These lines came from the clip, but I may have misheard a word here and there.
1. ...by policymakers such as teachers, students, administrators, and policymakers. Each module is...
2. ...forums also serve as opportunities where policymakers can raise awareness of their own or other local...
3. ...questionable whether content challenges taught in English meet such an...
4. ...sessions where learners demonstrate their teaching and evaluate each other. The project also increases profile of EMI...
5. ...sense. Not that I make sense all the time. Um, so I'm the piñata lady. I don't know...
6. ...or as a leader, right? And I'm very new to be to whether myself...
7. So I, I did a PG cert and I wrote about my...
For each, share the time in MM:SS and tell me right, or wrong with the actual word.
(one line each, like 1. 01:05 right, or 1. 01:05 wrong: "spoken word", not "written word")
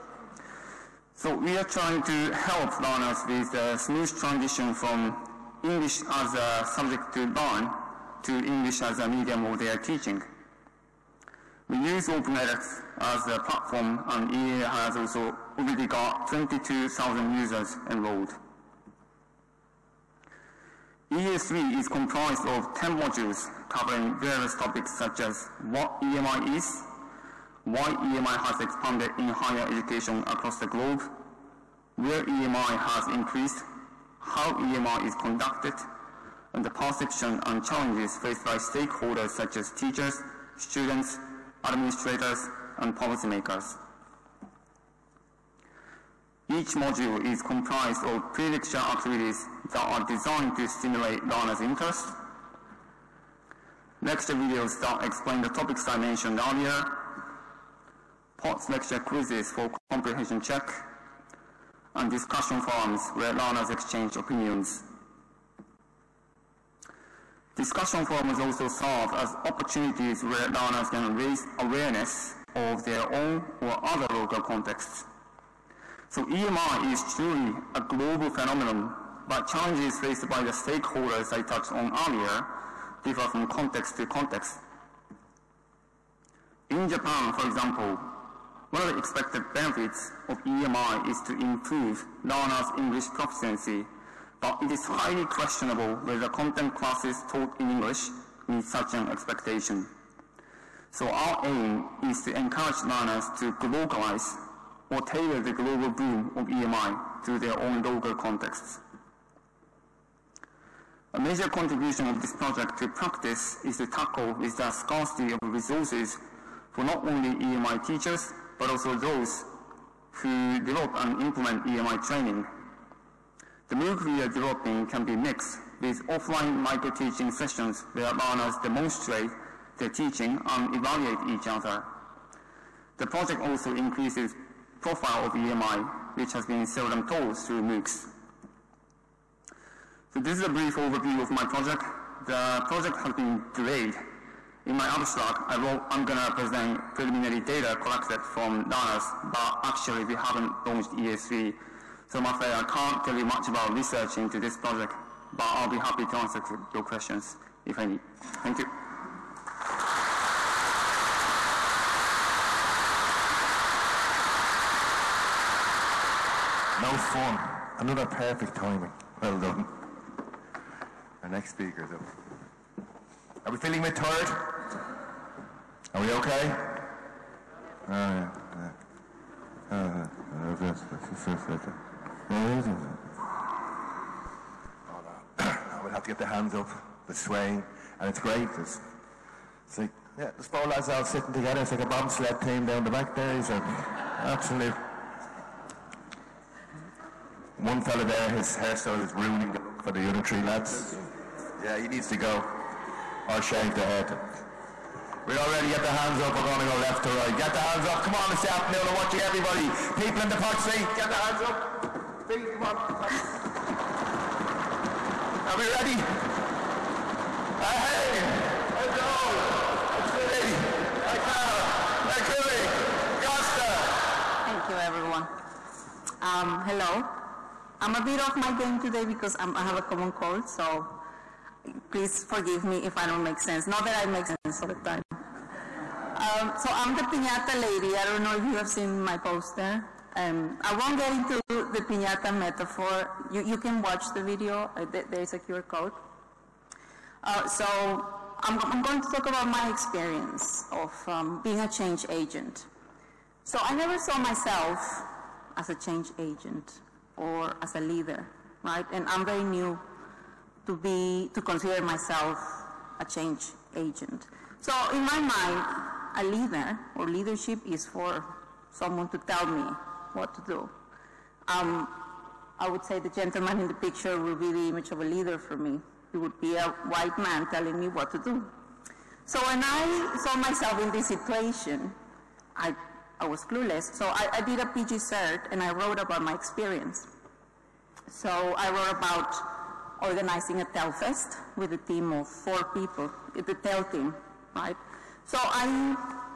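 1. 00:38 wrong: "stakeholders", not "policymakers"
2. 01:08 wrong: "learners", not "policymakers"
3. 01:35 wrong: "classes", not "challenges"
4. 02:07 right
5. 03:53 right
6. 04:17 wrong: "consider", not "whether"
7. 04:43 right.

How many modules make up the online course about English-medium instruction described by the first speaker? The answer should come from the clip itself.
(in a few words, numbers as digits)
10.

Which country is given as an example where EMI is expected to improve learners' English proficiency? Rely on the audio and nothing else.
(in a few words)
Japan.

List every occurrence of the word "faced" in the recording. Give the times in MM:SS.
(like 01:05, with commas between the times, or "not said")
00:38, 01:19.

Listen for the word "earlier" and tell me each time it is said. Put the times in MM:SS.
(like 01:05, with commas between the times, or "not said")
00:56, 01:21.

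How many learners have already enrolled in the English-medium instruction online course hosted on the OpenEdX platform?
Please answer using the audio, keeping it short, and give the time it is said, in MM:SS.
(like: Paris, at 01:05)
22,000, at 00:16.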